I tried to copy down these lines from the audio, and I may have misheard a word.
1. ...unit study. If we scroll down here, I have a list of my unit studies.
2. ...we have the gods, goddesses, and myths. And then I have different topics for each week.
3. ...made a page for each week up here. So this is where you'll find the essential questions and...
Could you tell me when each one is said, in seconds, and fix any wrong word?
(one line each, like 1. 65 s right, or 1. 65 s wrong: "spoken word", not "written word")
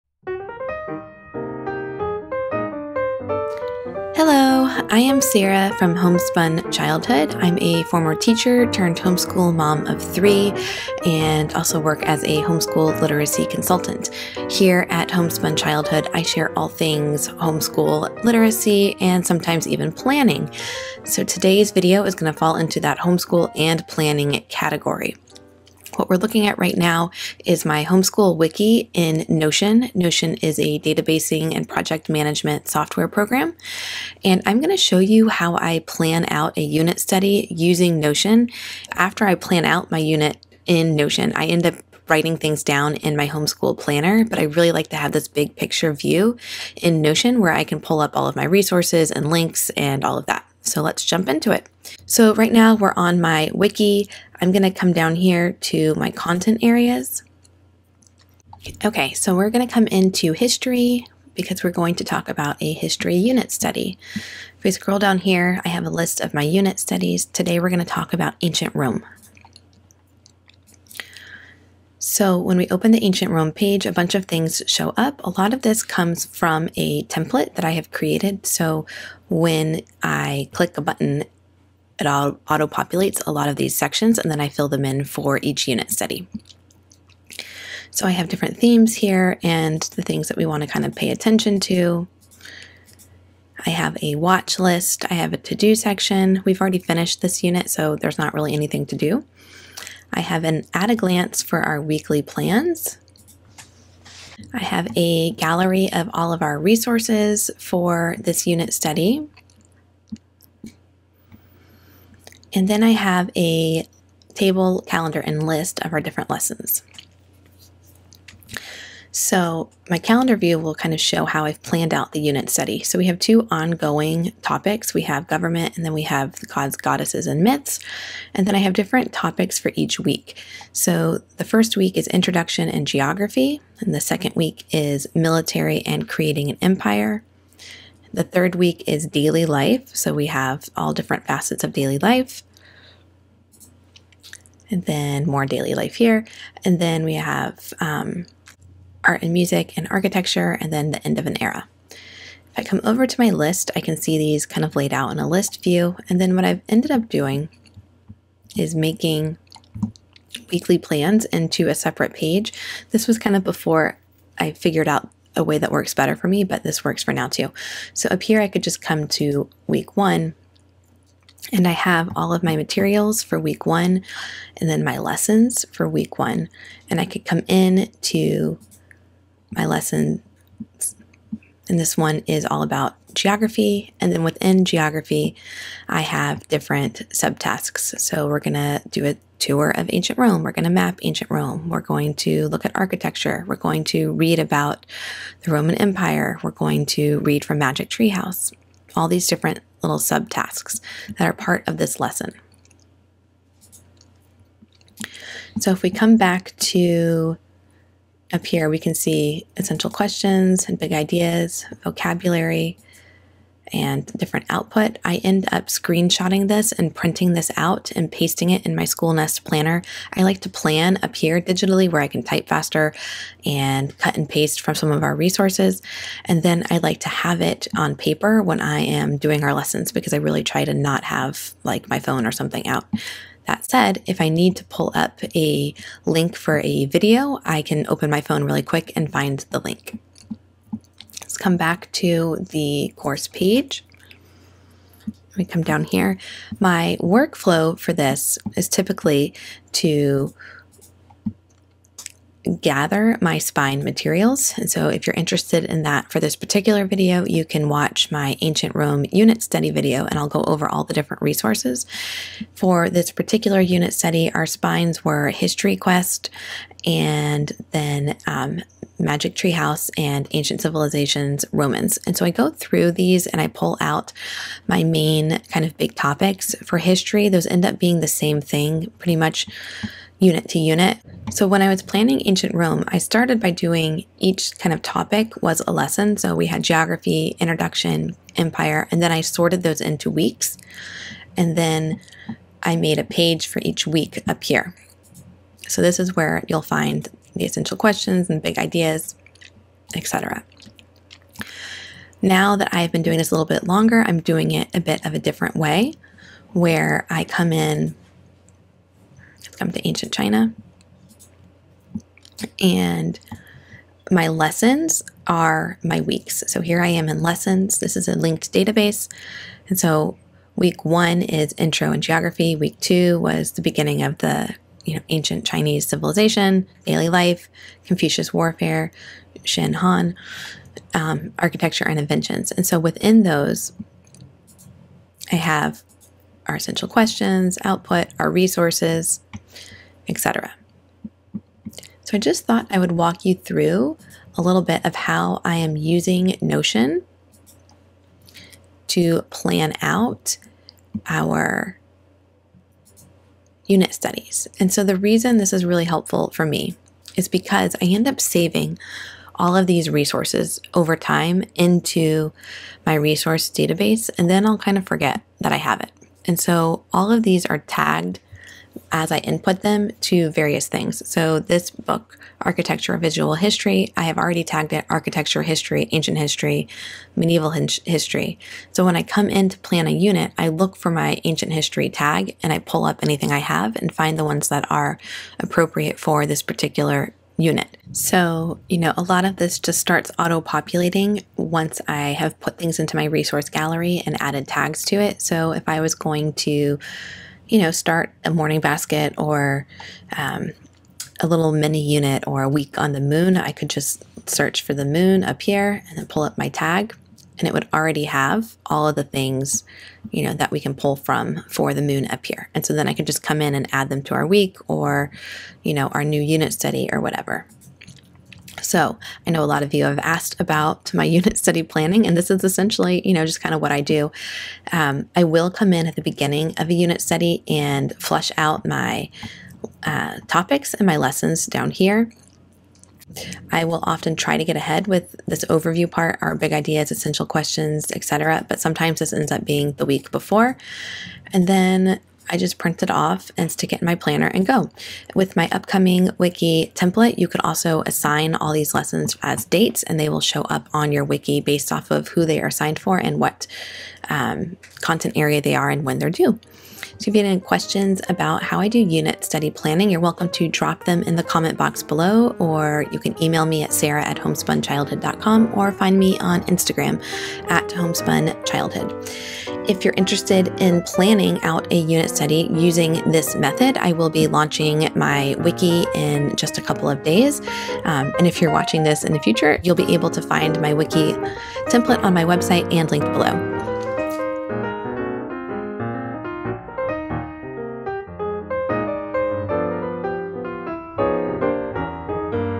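1. 63 s right
2. 125 s right
3. 292 s right.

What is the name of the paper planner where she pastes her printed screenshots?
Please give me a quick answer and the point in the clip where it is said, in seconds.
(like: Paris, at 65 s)
School Nest planner, at 218 s.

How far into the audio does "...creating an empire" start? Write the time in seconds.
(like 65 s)
136 s.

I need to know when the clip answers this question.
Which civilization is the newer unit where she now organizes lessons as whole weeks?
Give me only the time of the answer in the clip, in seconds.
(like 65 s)
309 s.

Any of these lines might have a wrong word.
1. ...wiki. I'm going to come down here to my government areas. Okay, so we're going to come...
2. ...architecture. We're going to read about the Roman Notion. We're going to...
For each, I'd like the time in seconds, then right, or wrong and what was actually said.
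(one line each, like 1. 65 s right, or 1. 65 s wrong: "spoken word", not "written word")
1. 53 s wrong: "content", not "government"
2. 192 s wrong: "Empire", not "Notion".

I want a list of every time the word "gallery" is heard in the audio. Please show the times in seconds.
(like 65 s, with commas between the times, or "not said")
105 s, 393 s.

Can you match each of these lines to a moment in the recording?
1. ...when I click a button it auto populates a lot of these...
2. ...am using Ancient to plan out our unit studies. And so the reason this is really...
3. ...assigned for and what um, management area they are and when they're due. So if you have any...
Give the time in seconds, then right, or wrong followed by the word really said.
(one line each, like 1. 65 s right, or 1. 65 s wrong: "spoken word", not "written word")
1. 79 s right
2. 345 s wrong: "Notion", not "Ancient"
3. 452 s wrong: "content", not "management".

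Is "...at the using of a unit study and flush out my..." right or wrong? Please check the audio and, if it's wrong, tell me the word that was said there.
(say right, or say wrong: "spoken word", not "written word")
wrong: "beginning", not "using".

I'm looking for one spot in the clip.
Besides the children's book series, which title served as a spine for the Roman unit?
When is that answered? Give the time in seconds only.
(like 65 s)
264 s.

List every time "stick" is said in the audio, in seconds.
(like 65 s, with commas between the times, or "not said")
443 s.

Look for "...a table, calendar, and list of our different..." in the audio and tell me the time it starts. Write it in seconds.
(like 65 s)
113 s.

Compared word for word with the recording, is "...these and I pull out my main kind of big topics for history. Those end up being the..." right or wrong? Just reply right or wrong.
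right.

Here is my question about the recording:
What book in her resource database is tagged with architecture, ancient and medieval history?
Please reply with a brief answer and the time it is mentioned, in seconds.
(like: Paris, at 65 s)
Architecture Visual History, at 372 s.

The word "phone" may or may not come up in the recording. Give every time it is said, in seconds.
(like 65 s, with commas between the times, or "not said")
231 s, 238 s.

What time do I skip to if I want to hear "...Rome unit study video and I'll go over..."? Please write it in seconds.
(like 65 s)
258 s.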